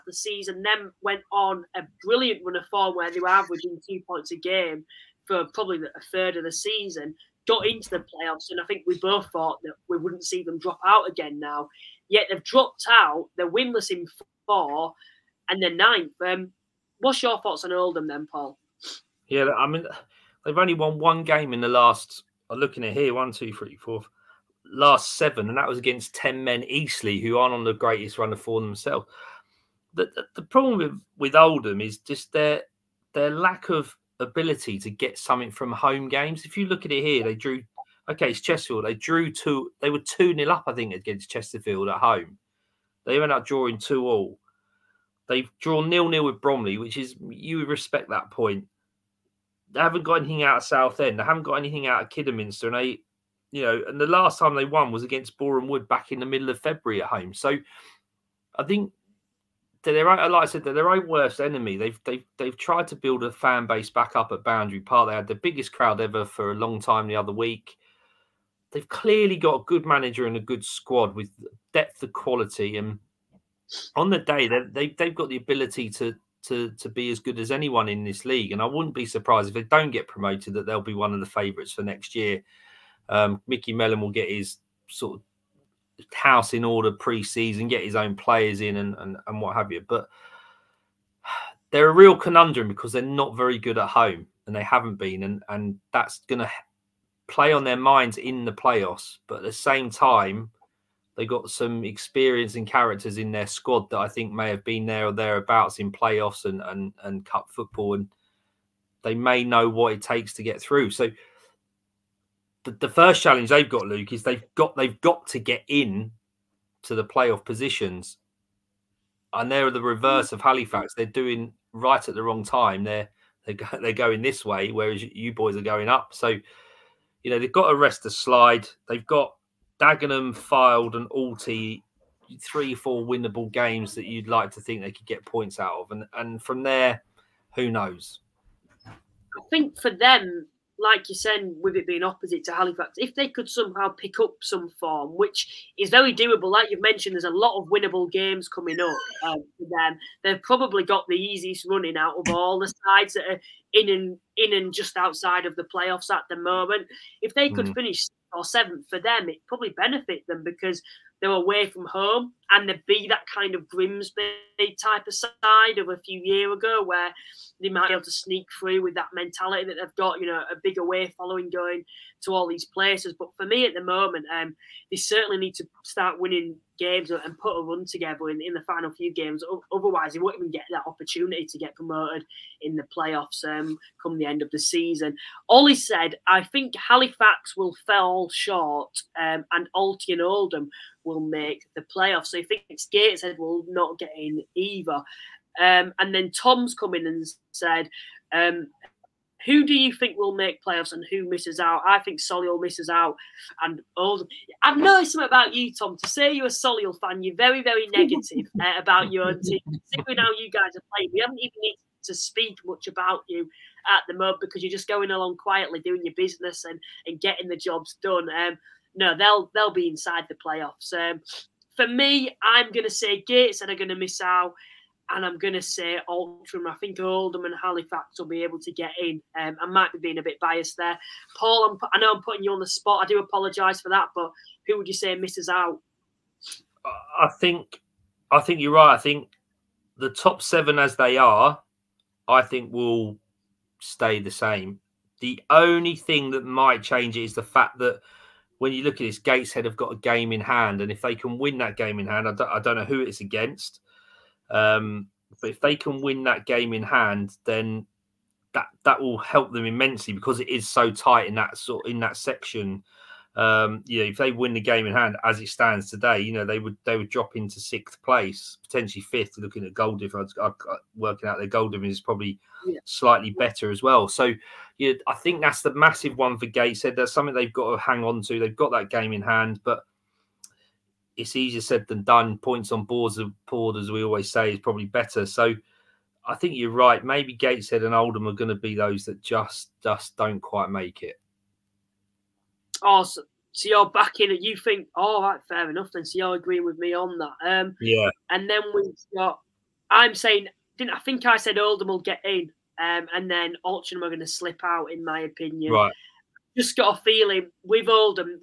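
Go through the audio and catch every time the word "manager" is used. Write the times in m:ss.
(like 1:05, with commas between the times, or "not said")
1:09.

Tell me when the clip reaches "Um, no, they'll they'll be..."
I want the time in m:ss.
3:38.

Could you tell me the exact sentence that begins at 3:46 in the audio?
I think Oldham and Halifax will be able to get in.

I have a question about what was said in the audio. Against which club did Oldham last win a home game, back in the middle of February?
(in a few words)
Boreham Wood.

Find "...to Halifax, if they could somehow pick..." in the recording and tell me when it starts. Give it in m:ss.
2:22.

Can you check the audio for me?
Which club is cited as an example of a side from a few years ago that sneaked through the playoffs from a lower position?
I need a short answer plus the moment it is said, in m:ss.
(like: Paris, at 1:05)
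Grimsby, at 2:43.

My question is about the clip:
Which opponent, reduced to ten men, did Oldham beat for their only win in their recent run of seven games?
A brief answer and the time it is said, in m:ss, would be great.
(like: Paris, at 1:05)
Eastleigh, at 0:26.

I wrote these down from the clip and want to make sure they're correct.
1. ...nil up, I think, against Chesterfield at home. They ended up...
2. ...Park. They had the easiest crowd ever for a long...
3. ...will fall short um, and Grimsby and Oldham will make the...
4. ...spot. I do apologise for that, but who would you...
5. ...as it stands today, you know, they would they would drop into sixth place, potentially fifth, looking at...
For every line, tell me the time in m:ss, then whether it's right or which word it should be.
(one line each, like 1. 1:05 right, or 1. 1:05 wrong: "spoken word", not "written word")
1. 0:40 right
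2. 1:04 wrong: "biggest", not "easiest"
3. 3:07 wrong: "Alty", not "Grimsby"
4. 3:52 right
5. 4:25 right.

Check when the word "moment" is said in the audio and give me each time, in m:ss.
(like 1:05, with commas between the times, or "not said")
2:36, 2:53, 3:34.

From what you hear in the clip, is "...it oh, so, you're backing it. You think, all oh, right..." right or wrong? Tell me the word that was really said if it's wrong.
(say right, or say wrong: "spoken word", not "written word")
right.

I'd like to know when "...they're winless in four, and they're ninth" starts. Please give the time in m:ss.
0:13.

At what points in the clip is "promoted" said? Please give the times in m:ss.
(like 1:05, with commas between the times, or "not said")
1:20, 3:01.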